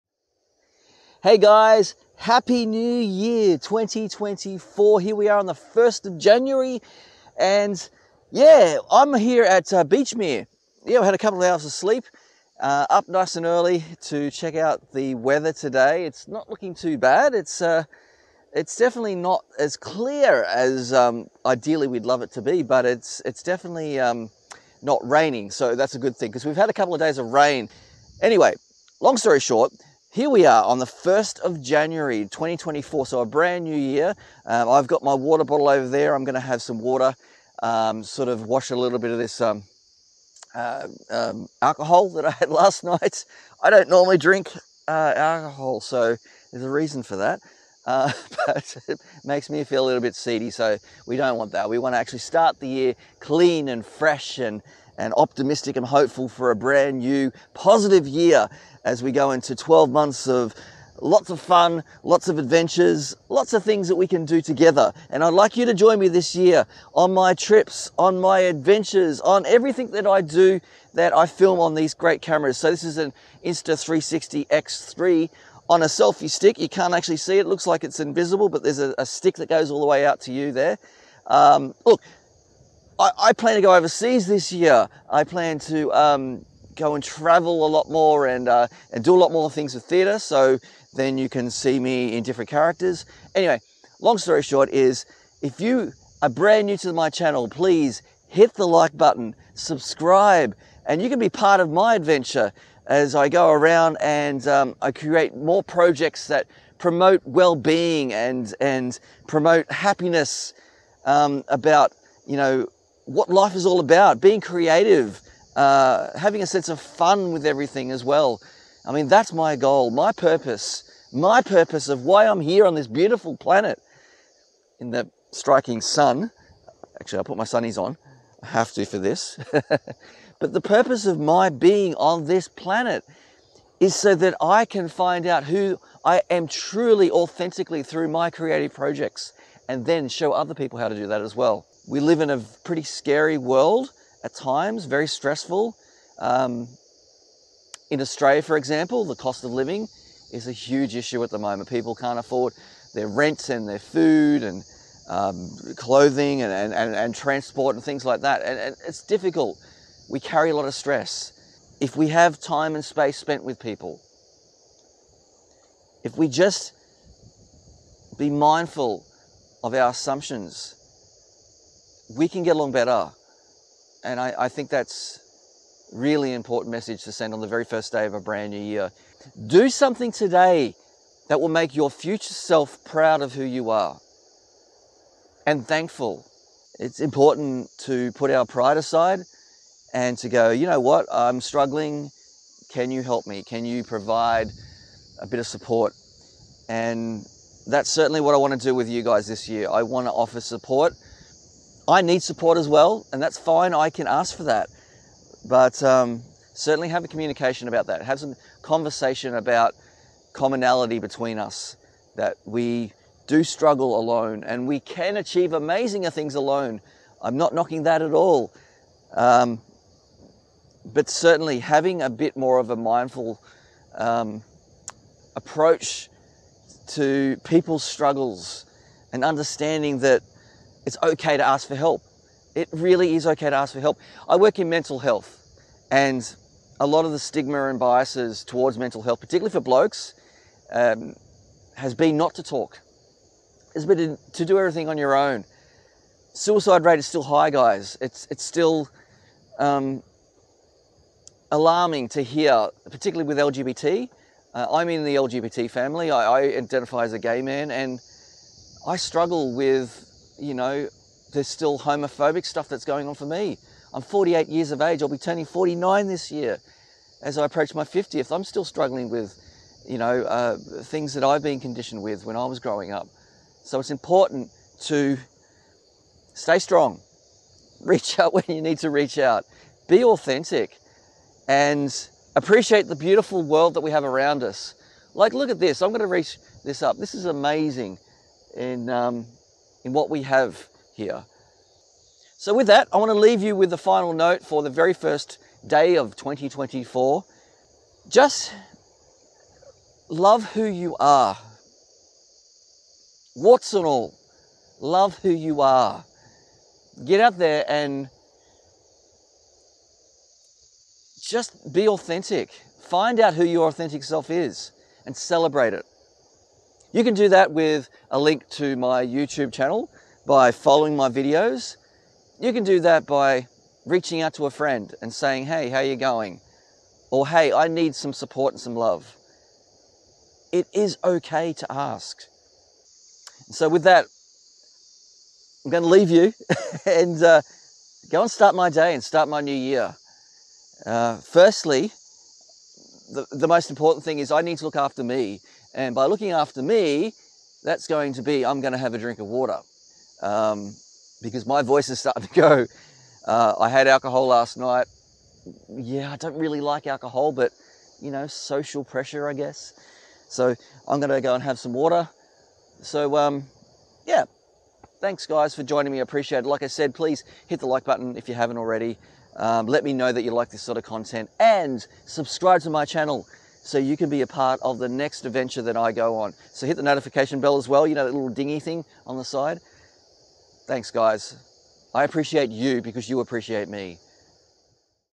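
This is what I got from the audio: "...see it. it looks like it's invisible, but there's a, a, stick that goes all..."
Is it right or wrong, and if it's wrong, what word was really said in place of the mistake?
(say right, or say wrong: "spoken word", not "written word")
right.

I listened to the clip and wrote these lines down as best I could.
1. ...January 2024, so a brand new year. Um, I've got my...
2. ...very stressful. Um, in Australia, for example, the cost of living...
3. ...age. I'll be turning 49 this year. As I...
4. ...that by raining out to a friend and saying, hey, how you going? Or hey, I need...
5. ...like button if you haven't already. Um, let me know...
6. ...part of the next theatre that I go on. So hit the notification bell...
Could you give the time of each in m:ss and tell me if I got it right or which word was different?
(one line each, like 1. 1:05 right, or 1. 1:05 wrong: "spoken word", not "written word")
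1. 0:31 right
2. 2:24 right
3. 4:24 right
4. 5:22 wrong: "reaching", not "raining"
5. 6:07 right
6. 6:14 wrong: "adventure", not "theatre".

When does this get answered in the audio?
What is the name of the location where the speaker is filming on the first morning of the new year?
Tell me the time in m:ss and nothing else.
0:09.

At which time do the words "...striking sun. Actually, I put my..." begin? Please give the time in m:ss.
2:05.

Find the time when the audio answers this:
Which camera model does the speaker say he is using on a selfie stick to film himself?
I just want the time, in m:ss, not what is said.
1:13.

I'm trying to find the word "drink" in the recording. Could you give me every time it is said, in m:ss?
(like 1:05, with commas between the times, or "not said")
0:44, 5:48.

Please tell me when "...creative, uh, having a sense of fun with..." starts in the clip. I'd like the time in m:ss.
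1:54.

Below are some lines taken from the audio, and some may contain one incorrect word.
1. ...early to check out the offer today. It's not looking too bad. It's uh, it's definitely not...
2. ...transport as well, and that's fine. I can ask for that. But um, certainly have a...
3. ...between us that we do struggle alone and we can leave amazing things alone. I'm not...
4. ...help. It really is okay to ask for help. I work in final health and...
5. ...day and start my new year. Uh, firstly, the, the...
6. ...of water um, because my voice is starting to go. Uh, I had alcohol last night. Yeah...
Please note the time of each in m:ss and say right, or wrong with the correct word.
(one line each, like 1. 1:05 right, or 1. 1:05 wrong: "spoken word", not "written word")
1. 0:13 wrong: "weather", not "offer"
2. 3:22 wrong: "support", not "transport"
3. 3:30 wrong: "achieve", not "leave"
4. 3:51 wrong: "mental", not "final"
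5. 5:38 right
6. 5:49 right.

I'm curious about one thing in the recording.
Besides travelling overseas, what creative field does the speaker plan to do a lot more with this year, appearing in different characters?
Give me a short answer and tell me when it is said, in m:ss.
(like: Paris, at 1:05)
Theatre, at 1:29.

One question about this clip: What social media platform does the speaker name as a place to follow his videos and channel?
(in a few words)
YouTube.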